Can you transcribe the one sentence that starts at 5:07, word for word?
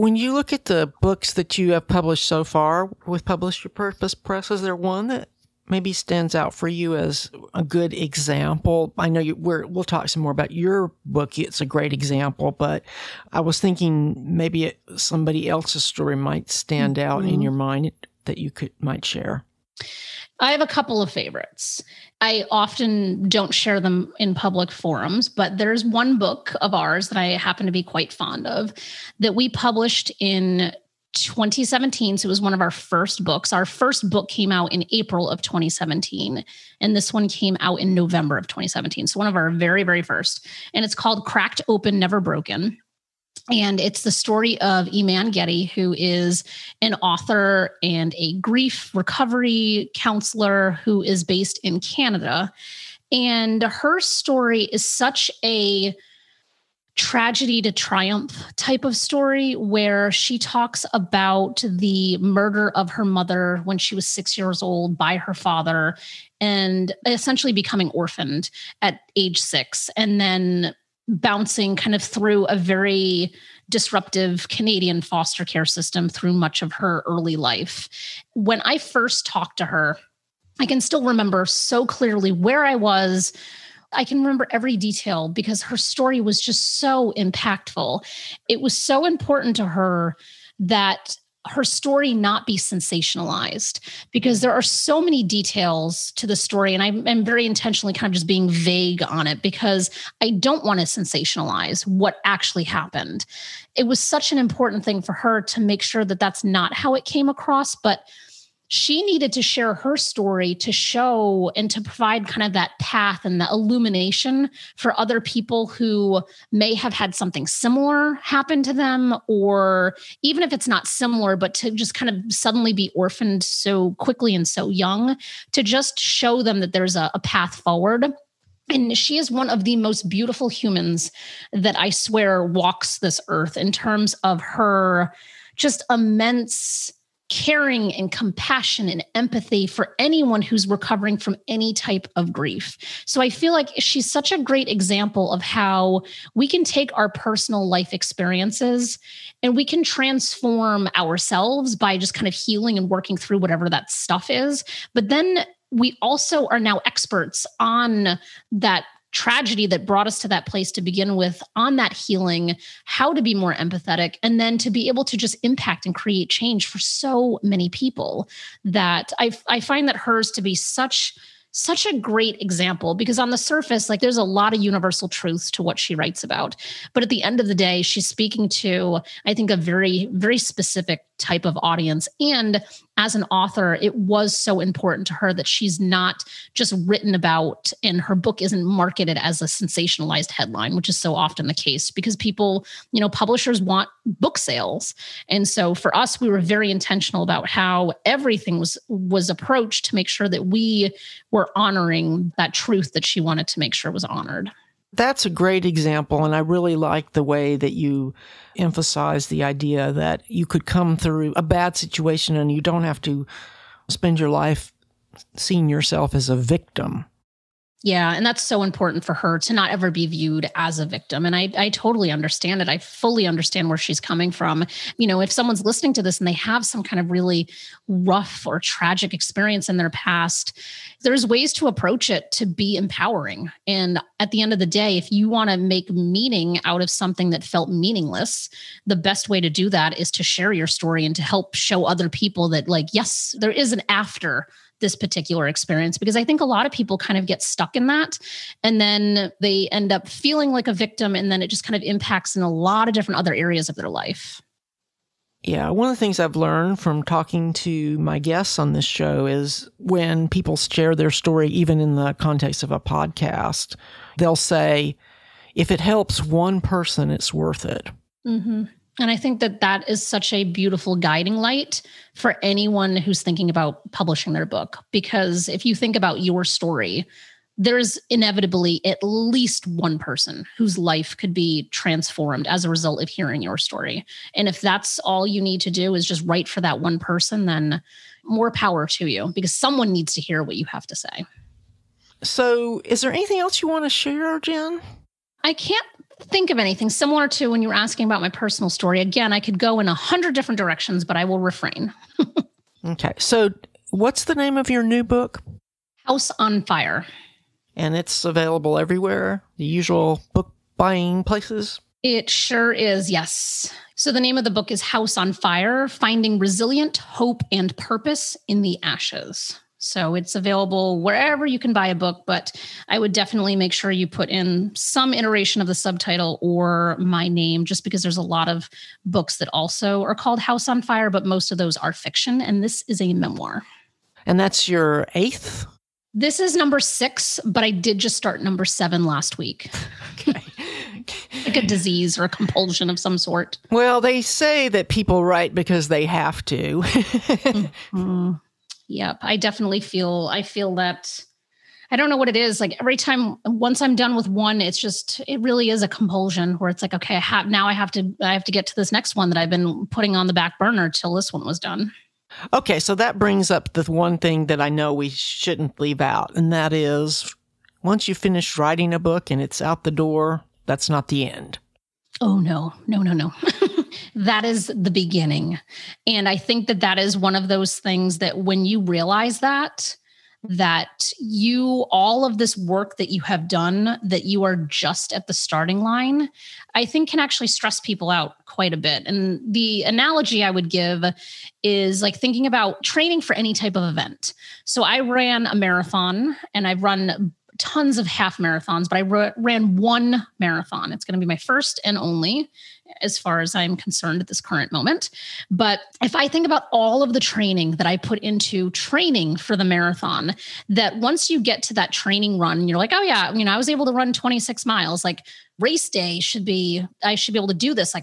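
And it's available everywhere, the usual book buying places.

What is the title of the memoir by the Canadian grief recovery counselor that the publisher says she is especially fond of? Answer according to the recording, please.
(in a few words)
Cracked Open, Never Broken.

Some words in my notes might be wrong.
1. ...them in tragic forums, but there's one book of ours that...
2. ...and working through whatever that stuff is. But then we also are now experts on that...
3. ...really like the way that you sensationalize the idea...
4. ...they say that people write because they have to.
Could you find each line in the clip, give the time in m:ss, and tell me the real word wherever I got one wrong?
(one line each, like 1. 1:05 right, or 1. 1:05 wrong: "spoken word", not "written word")
1. 0:23 wrong: "public", not "tragic"
2. 2:32 right
3. 3:26 wrong: "emphasize", not "sensationalize"
4. 5:44 right.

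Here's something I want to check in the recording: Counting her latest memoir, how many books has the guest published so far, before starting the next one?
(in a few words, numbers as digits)
6.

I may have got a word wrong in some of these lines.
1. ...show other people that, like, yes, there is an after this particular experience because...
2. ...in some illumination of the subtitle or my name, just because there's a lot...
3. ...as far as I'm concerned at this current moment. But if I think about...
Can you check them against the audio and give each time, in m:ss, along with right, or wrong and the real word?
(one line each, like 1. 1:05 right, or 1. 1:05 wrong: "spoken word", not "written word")
1. 4:01 right
2. 5:24 wrong: "iteration", not "illumination"
3. 6:43 right.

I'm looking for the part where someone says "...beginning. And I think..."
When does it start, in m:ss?
6:14.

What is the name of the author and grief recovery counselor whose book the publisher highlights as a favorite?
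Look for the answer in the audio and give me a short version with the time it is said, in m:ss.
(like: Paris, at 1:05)
Eman Getty, at 0:44.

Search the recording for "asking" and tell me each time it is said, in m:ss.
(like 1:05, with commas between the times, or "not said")
4:57.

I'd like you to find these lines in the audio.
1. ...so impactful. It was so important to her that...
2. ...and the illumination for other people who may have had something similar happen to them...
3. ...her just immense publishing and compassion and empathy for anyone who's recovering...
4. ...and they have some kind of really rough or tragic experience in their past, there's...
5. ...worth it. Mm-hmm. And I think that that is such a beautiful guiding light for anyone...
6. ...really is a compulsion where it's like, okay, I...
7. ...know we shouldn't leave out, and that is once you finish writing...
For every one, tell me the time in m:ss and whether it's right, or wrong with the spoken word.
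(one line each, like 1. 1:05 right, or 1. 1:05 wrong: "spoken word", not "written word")
1. 1:26 right
2. 1:53 right
3. 2:14 wrong: "caring", not "publishing"
4. 3:46 right
5. 4:27 right
6. 5:55 right
7. 6:04 right.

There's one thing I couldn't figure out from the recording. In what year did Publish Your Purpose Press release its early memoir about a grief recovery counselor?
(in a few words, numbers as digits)
2017.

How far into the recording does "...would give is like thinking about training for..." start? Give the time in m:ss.
6:30.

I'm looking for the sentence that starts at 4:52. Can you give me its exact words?
So, is there anything else you want to share, Jenn?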